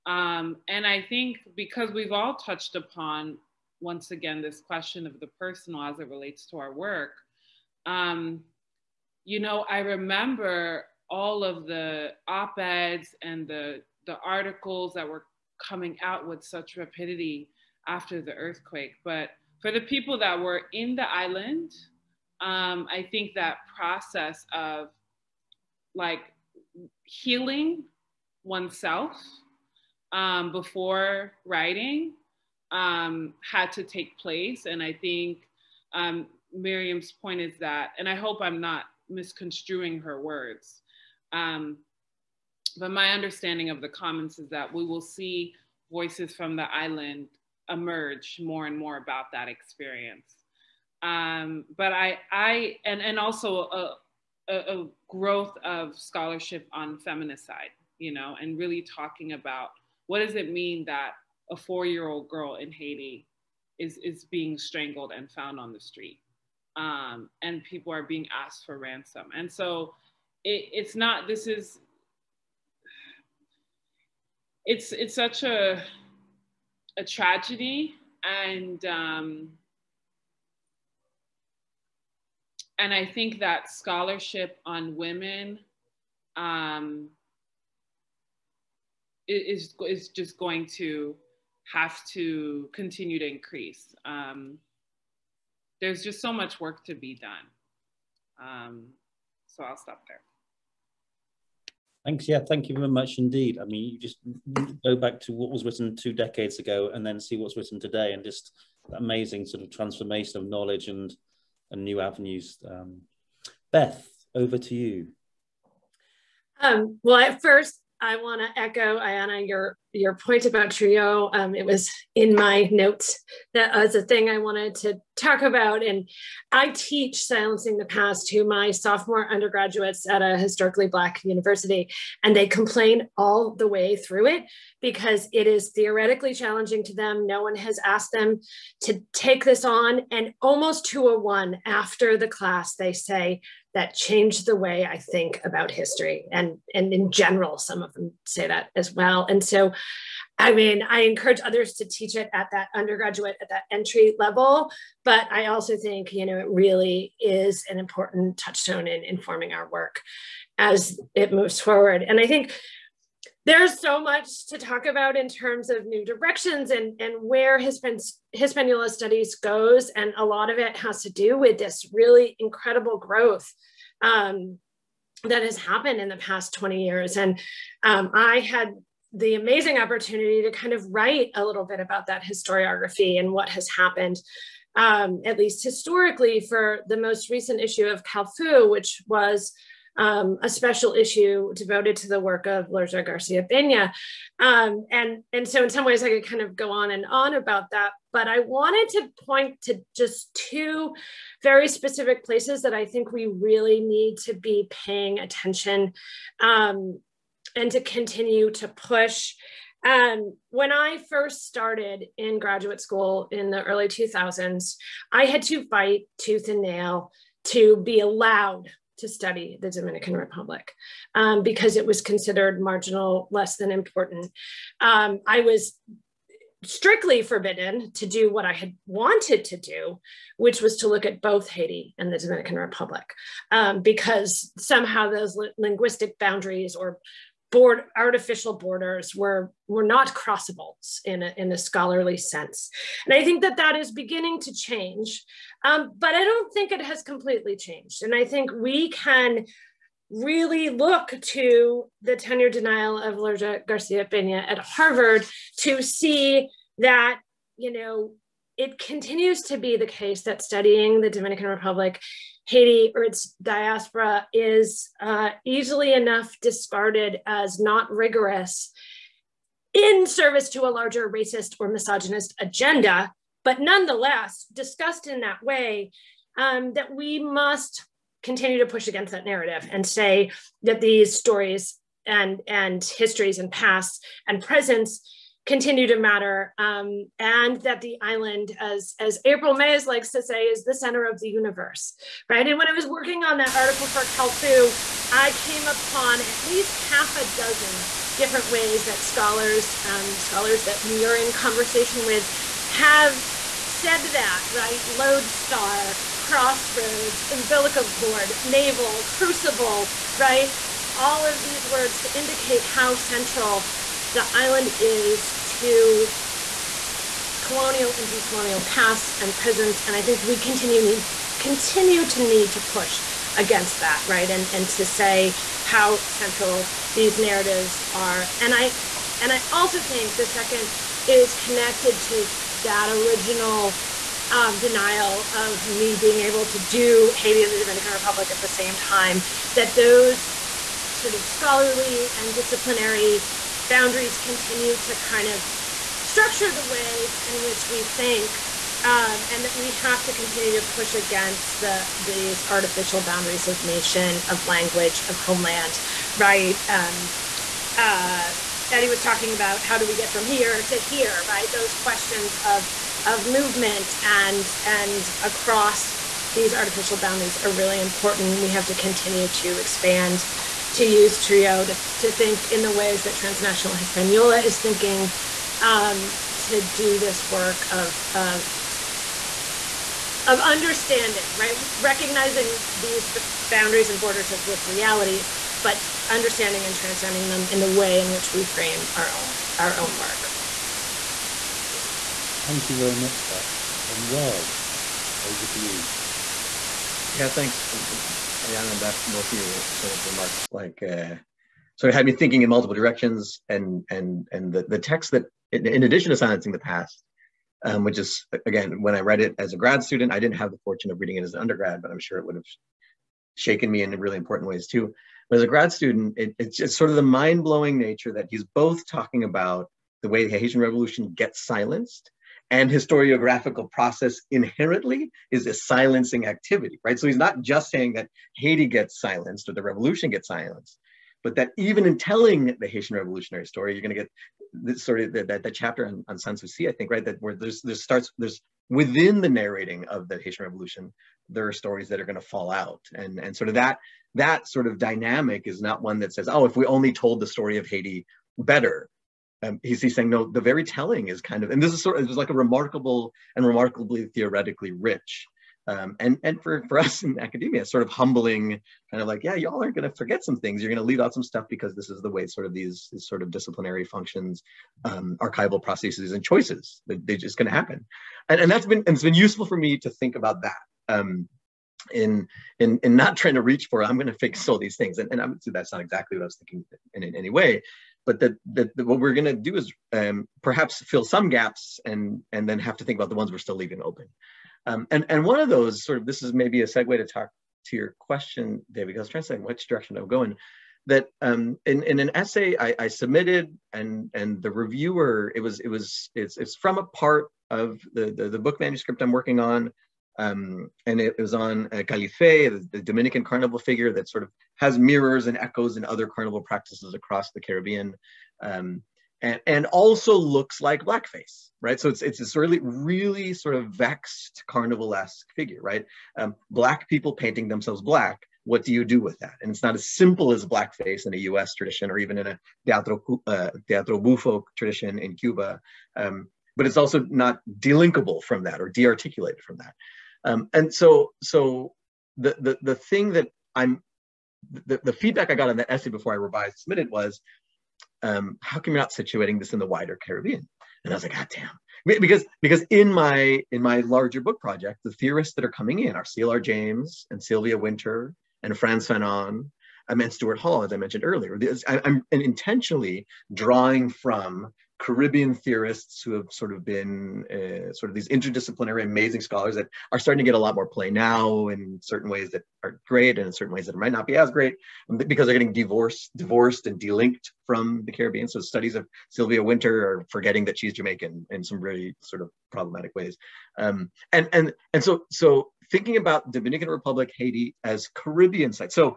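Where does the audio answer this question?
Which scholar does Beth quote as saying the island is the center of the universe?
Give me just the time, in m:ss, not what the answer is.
4:49.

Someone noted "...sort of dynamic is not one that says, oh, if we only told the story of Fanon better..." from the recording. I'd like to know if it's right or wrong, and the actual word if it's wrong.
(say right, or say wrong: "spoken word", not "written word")
wrong: "Haiti", not "Fanon".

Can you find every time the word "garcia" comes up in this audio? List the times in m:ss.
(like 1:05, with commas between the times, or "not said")
3:13, 4:13.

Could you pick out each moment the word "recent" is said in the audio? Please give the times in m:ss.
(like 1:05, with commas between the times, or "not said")
3:07.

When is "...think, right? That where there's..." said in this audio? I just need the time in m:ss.
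7:16.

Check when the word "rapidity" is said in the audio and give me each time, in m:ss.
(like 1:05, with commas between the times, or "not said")
0:16.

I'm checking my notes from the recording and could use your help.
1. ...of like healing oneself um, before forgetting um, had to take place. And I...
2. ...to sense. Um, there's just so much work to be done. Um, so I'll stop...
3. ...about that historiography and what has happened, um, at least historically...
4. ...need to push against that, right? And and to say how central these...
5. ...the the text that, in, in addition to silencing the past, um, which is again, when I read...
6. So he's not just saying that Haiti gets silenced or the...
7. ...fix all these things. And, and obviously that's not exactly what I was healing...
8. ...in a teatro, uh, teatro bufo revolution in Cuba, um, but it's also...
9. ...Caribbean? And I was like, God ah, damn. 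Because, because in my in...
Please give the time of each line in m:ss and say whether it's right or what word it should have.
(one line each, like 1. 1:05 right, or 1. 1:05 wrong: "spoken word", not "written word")
1. 0:24 wrong: "writing", not "forgetting"
2. 1:33 wrong: "increase", not "sense"
3. 3:01 right
4. 5:22 right
5. 6:44 right
6. 7:06 right
7. 7:54 wrong: "thinking", not "healing"
8. 8:42 wrong: "tradition", not "revolution"
9. 8:59 right.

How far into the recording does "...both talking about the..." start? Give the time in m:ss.
6:58.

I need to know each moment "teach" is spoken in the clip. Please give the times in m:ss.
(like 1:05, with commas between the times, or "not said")
2:06, 2:31.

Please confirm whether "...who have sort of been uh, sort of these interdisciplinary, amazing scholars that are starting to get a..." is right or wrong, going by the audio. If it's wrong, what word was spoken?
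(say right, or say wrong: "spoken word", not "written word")
right.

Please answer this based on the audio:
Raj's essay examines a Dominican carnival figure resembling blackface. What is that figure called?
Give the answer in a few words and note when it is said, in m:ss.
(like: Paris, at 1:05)
Califé, at 8:21.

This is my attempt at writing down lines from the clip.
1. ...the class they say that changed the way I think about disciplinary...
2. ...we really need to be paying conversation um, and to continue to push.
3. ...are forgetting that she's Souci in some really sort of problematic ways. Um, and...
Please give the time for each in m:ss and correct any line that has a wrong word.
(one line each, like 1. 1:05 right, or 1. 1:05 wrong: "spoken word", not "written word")
1. 2:22 wrong: "history", not "disciplinary"
2. 3:23 wrong: "attention", not "conversation"
3. 9:29 wrong: "Jamaican", not "Souci".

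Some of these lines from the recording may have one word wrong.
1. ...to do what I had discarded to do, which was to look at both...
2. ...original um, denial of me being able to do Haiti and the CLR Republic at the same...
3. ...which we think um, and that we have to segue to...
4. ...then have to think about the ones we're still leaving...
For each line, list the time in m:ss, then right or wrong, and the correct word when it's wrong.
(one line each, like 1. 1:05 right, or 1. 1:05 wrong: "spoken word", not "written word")
1. 3:47 wrong: "wanted", not "discarded"
2. 5:32 wrong: "Dominican", not "CLR"
3. 5:47 wrong: "continue", not "segue"
4. 8:02 right.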